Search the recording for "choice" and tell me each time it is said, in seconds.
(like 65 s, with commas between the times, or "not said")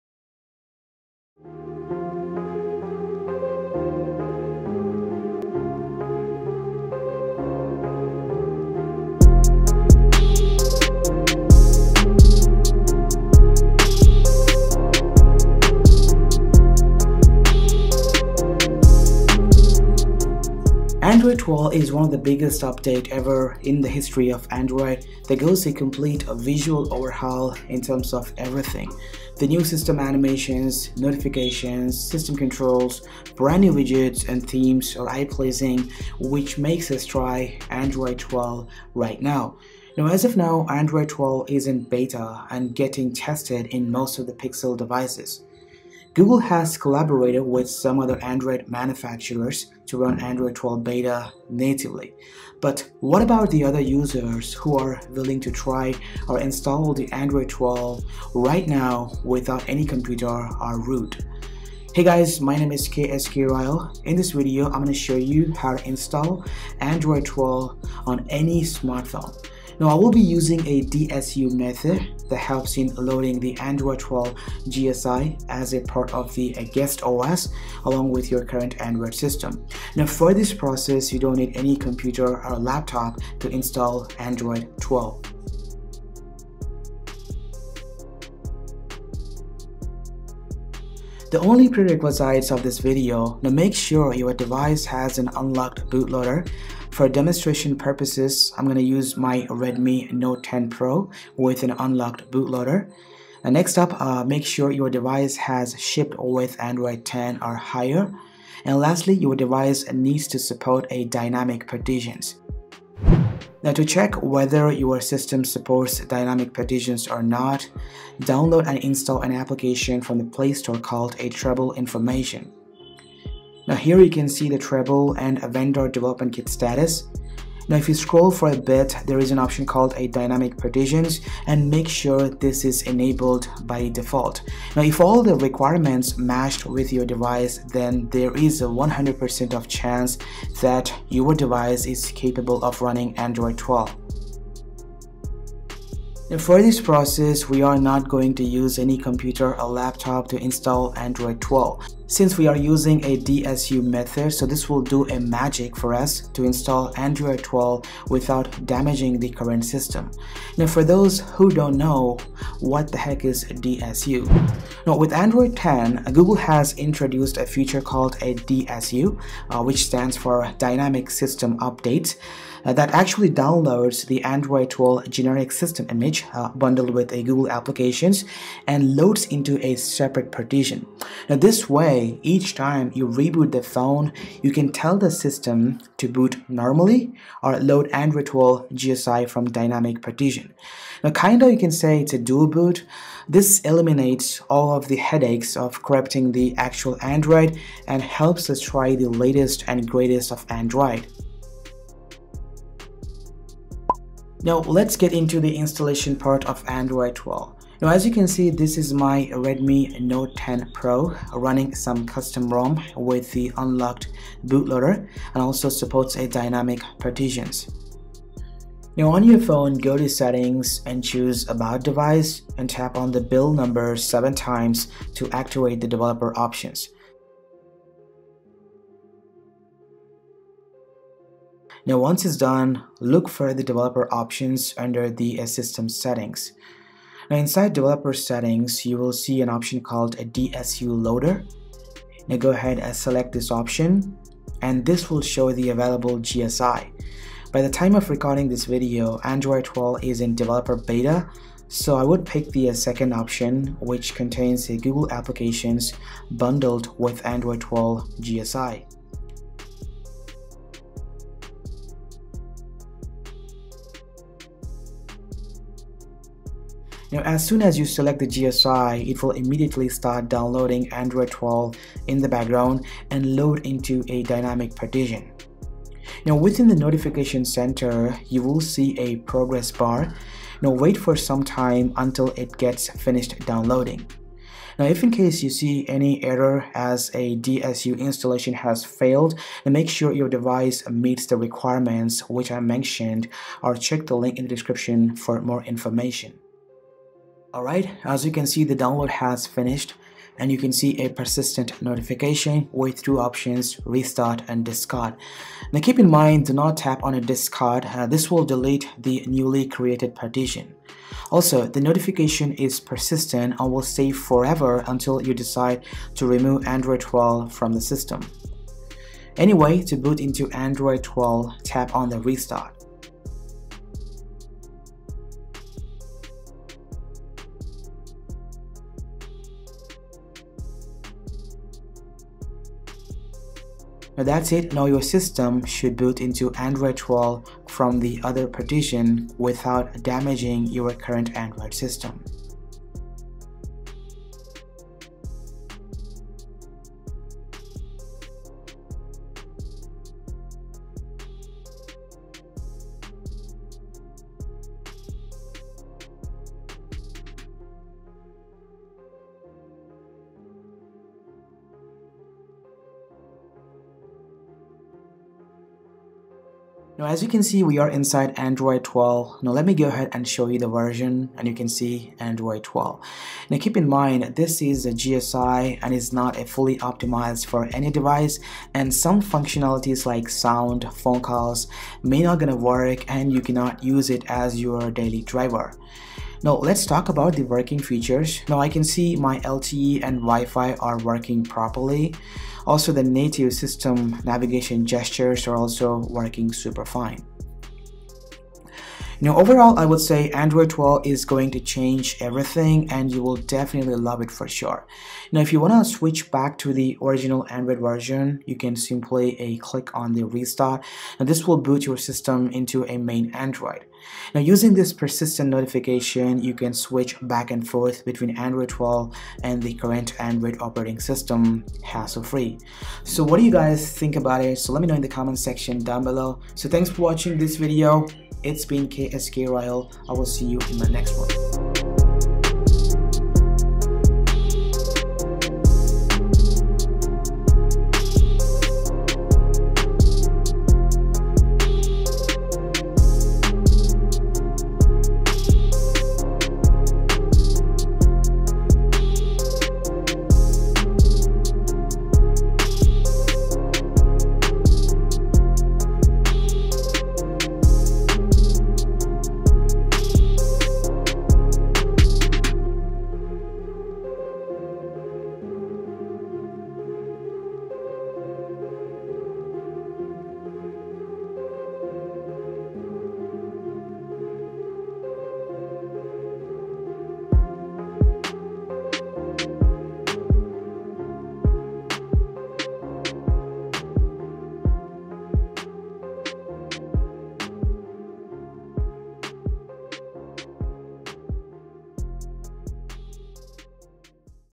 not said.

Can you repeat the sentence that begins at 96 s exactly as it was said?
For demonstration purposes, I'm gonna use my Redmi Note 10 Pro with an unlocked bootloader.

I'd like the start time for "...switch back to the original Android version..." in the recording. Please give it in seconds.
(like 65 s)
405 s.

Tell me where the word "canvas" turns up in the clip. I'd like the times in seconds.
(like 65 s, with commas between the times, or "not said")
not said.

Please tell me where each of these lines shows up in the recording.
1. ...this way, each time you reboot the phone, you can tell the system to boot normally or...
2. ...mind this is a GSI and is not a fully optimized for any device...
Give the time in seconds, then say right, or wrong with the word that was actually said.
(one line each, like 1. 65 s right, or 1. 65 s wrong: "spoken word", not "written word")
1. 181 s right
2. 373 s right.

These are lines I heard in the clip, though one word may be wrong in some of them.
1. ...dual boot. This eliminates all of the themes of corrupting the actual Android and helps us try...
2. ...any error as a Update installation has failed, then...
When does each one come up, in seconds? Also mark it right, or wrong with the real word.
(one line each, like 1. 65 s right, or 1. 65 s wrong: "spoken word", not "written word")
1. 192 s wrong: "headaches", not "themes"
2. 285 s wrong: "DSU", not "Update".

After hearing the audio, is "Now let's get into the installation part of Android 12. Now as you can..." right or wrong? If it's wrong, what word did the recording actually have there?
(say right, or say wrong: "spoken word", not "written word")
right.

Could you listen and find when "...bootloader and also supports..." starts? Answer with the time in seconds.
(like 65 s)
214 s.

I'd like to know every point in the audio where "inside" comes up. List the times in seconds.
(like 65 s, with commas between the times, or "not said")
237 s, 367 s.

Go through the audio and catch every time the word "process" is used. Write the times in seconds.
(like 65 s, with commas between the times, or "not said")
80 s, 146 s.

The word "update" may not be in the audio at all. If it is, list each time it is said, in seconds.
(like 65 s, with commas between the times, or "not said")
22 s, 171 s.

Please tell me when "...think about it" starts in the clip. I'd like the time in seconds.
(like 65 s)
423 s.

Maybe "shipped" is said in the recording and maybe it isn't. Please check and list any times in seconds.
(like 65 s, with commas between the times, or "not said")
105 s.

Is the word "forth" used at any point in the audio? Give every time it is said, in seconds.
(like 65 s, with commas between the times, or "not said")
417 s.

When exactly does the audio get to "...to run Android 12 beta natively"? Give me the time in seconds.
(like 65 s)
49 s.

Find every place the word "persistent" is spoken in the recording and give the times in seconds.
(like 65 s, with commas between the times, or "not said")
301 s, 312 s, 414 s.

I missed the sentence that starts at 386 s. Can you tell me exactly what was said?
Now let's talk about the working features.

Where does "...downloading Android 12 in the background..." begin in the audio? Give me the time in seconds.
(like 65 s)
270 s.